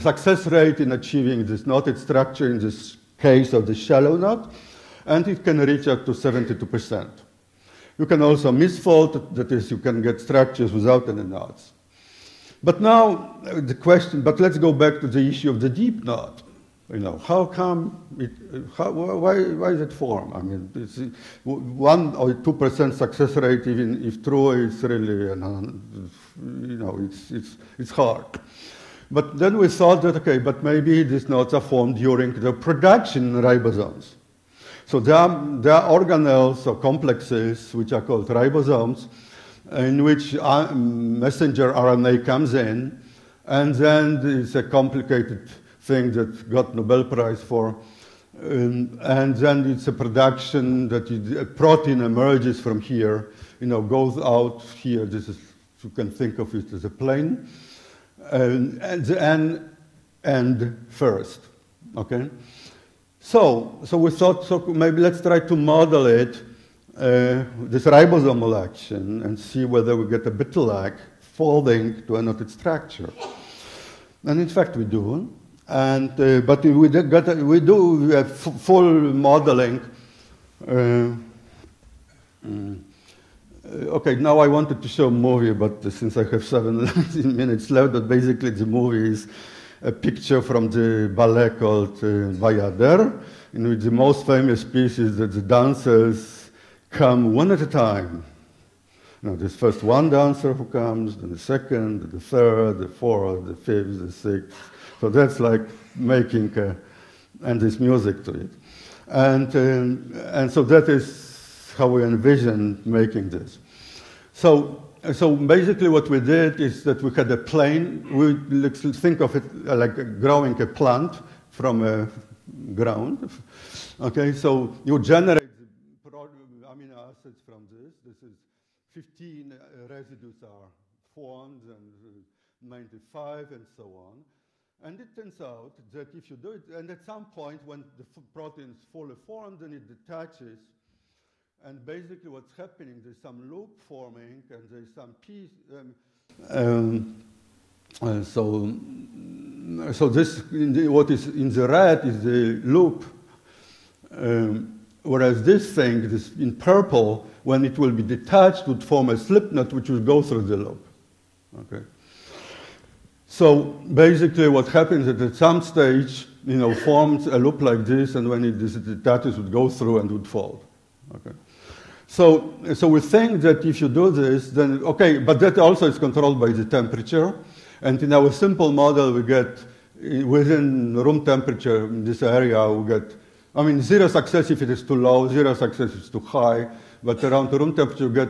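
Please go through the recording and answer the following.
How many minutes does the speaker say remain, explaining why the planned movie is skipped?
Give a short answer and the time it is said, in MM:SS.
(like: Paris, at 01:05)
17, at 01:26.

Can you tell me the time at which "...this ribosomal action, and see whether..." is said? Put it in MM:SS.
01:07.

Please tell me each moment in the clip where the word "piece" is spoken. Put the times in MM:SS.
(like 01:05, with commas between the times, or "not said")
01:34, 02:25.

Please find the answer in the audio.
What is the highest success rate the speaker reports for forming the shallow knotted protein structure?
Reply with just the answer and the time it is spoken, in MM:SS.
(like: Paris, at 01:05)
72 percent, at 00:06.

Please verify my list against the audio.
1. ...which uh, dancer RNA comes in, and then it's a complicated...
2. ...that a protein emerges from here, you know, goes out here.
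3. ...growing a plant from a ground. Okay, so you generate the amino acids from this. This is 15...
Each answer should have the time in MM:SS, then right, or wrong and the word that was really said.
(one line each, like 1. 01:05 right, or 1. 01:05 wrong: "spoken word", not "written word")
1. 00:40 wrong: "messenger", not "dancer"
2. 00:50 right
3. 02:00 right.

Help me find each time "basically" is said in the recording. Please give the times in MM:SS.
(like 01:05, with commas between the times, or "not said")
01:28, 01:55, 02:21, 02:43.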